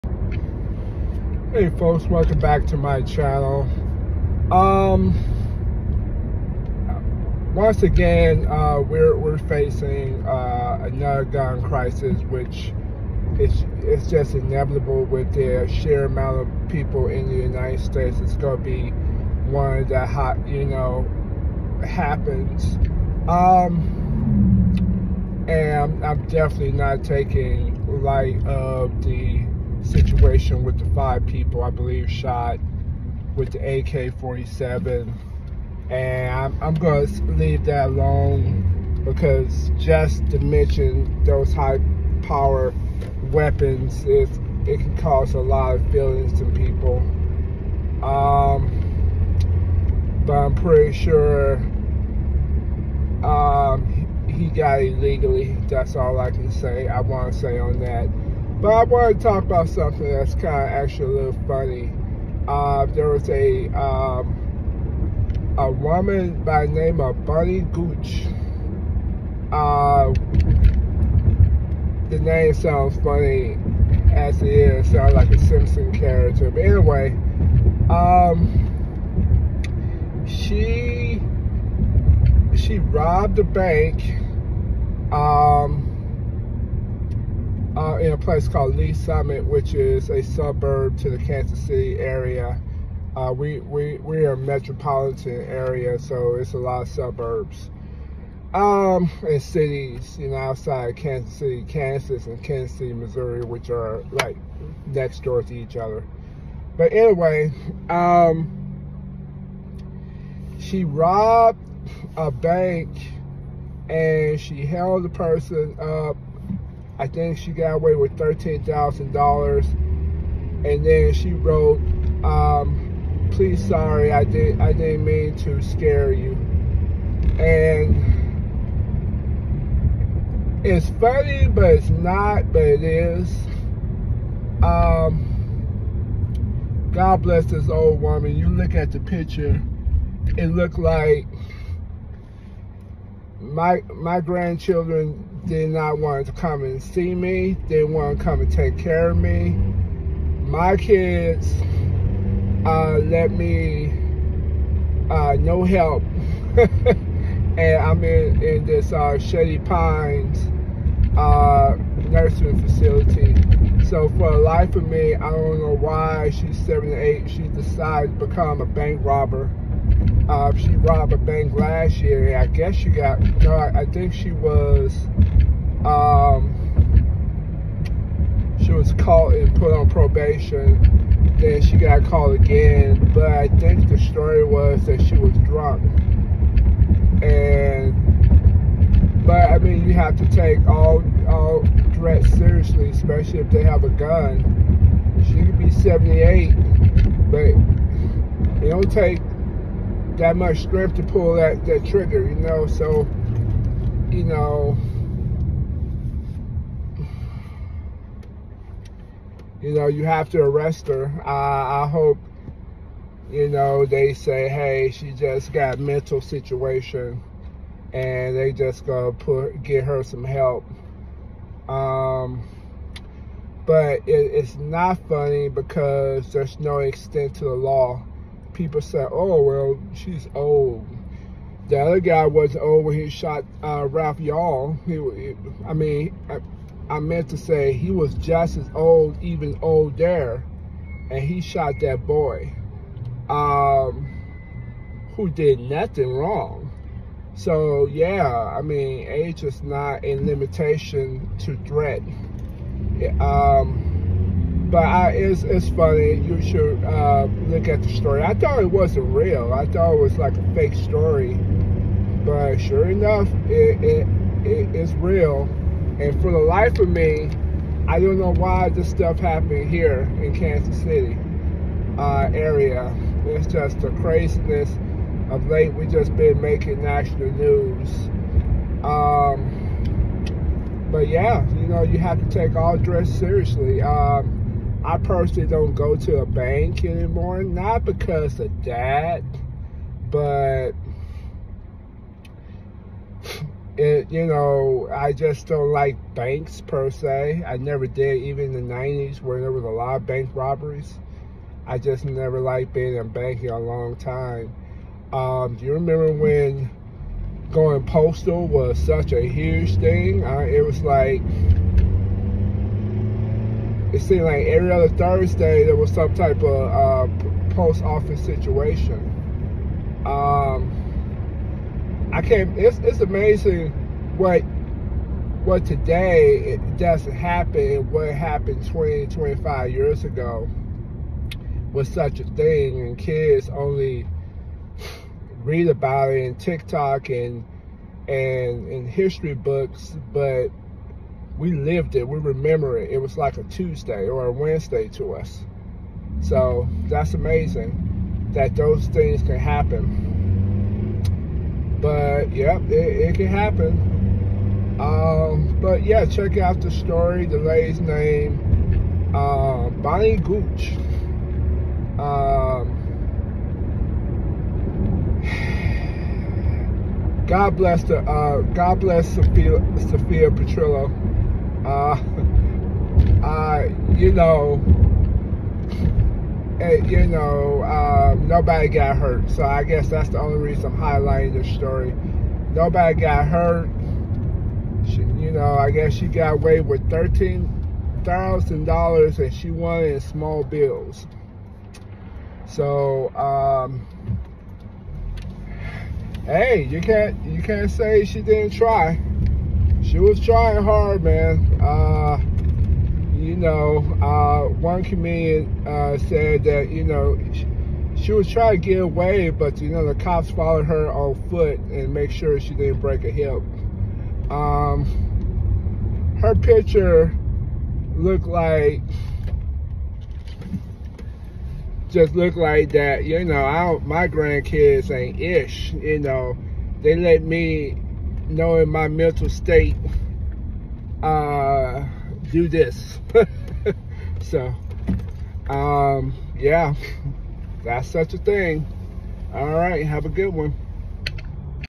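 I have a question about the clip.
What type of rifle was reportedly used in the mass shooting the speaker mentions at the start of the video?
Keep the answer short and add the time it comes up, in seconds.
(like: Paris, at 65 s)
AK-47, at 33 s.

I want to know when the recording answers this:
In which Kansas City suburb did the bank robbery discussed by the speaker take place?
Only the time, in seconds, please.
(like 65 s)
88 s.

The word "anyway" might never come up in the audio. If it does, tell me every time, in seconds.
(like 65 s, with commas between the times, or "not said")
76 s, 106 s.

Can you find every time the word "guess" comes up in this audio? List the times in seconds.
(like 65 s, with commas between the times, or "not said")
172 s, 379 s, 385 s.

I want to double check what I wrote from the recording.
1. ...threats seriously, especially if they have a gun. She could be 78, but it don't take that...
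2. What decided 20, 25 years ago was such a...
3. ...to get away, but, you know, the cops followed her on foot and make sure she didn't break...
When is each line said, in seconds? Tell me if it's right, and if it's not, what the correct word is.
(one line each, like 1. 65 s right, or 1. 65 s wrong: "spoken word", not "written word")
1. 191 s right
2. 327 s wrong: "happened", not "decided"
3. 408 s right.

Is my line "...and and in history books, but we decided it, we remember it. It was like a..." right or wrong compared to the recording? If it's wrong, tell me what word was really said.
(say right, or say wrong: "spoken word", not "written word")
wrong: "lived", not "decided".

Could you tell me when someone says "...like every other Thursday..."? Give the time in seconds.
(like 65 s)
314 s.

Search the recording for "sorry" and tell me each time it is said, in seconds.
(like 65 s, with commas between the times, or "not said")
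123 s.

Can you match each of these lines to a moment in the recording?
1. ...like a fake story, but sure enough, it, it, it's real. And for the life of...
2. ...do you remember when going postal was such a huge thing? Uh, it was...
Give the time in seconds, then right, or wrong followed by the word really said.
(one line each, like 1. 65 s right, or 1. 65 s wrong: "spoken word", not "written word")
1. 260 s right
2. 305 s right.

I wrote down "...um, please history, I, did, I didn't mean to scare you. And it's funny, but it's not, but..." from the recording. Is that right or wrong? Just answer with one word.
wrong.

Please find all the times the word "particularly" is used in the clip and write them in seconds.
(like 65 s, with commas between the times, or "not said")
not said.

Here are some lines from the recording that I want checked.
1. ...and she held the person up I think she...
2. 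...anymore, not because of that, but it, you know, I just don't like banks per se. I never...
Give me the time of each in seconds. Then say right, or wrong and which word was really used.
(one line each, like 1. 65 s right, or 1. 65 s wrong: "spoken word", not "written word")
1. 113 s right
2. 286 s right.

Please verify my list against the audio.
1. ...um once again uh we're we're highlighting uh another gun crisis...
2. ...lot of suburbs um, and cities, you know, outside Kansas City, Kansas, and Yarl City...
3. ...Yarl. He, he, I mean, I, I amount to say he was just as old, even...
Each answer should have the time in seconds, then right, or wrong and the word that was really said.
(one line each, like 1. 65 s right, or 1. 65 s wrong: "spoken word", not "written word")
1. 4 s wrong: "facing", not "highlighting"
2. 96 s wrong: "Kansas", not "Yarl"
3. 234 s wrong: "meant", not "amount".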